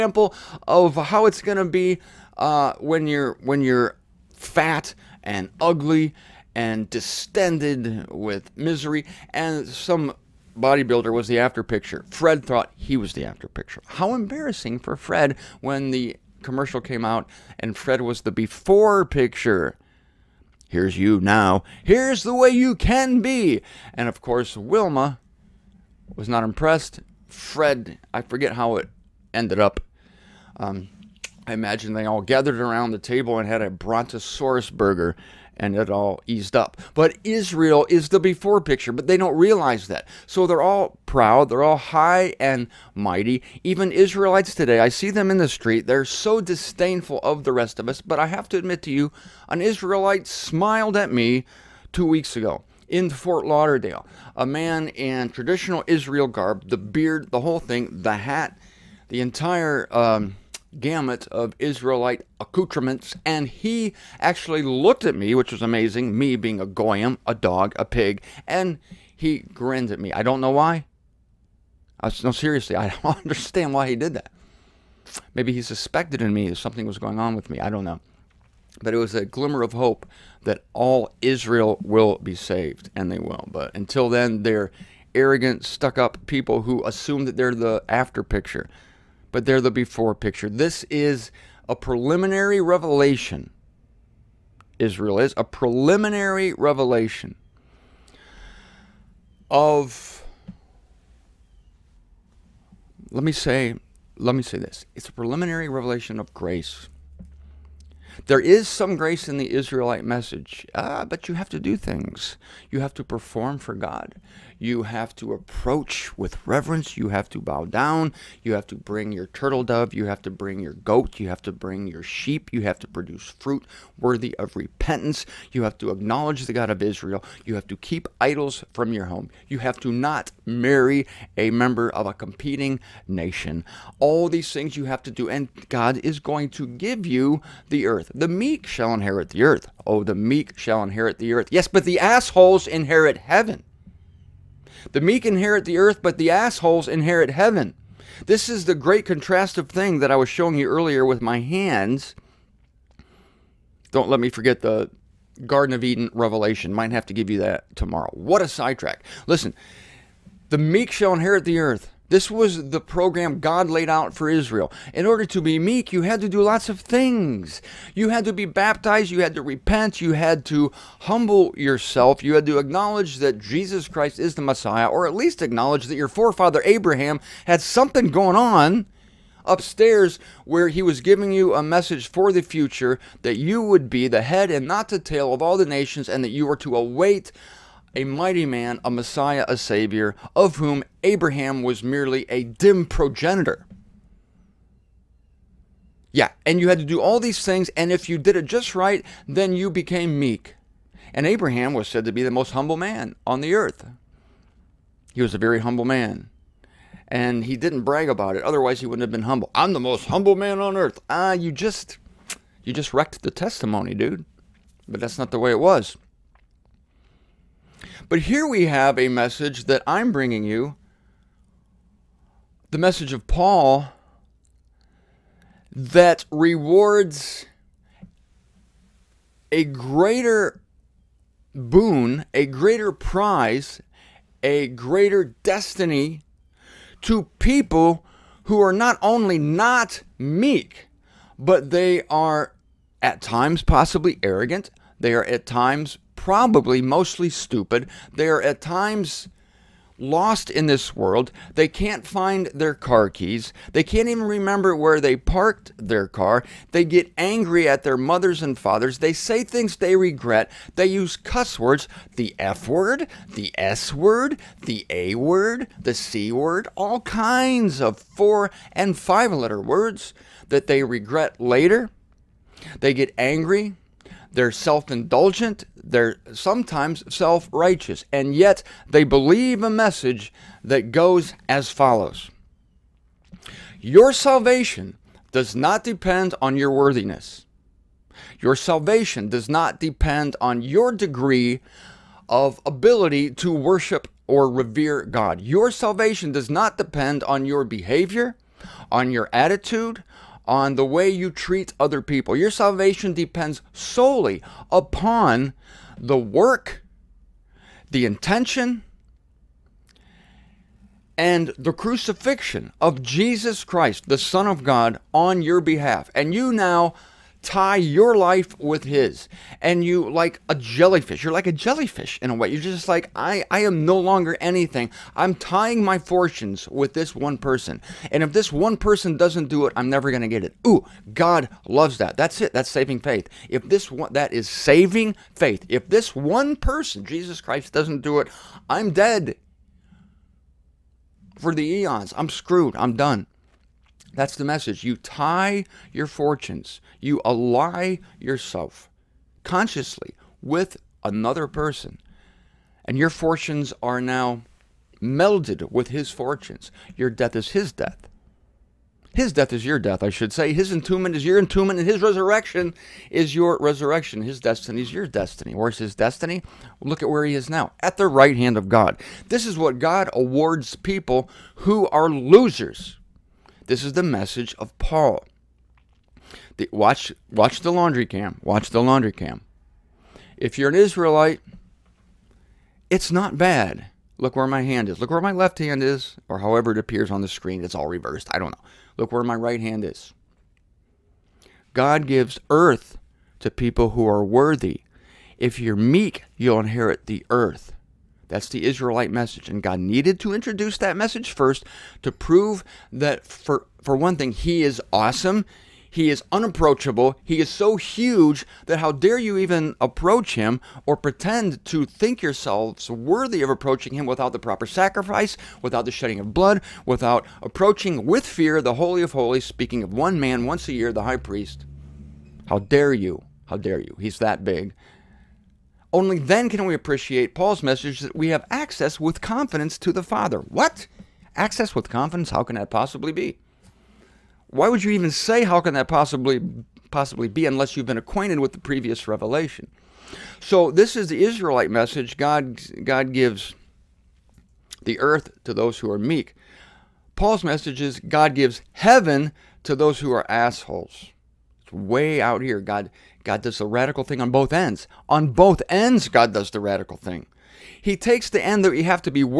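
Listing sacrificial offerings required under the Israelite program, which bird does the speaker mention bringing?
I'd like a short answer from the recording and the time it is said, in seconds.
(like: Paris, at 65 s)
turtle dove, at 119 s.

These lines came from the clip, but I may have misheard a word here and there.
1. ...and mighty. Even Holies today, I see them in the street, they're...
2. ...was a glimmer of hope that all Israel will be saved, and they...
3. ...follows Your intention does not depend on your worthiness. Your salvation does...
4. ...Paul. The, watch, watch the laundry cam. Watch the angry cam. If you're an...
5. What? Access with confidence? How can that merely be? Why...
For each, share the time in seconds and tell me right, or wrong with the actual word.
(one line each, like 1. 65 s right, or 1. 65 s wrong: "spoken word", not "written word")
1. 42 s wrong: "Israelites", not "Holies"
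2. 78 s right
3. 281 s wrong: "salvation", not "intention"
4. 374 s wrong: "laundry", not "angry"
5. 430 s wrong: "possibly", not "merely".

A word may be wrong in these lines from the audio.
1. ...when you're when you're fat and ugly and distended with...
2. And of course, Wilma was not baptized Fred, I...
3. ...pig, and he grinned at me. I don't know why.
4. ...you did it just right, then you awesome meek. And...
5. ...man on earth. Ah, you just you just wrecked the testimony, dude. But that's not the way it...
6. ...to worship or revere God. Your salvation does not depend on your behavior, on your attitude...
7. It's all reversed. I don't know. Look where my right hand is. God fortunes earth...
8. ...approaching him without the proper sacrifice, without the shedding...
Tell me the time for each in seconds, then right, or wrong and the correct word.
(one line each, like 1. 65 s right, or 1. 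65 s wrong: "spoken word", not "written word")
1. 2 s right
2. 23 s wrong: "impressed", not "baptized"
3. 67 s right
4. 198 s wrong: "became", not "awesome"
5. 210 s right
6. 293 s right
7. 387 s wrong: "gives", not "fortunes"
8. 413 s right.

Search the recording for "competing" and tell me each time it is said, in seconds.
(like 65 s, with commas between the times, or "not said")
132 s.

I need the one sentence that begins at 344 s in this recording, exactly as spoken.
You tie your fortunes, you ally yourself consciously with another person, and your fortunes are now melded with his fortunes.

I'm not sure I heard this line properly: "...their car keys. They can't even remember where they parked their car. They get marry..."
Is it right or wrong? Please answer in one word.
wrong.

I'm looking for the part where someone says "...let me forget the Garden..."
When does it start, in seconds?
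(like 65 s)
154 s.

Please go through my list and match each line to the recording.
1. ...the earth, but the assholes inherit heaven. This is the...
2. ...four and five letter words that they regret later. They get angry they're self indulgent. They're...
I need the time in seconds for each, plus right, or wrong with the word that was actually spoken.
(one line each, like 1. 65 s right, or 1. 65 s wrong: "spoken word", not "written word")
1. 145 s right
2. 267 s right.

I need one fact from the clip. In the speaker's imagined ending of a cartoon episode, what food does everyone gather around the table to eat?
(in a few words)
brontosaurus burger.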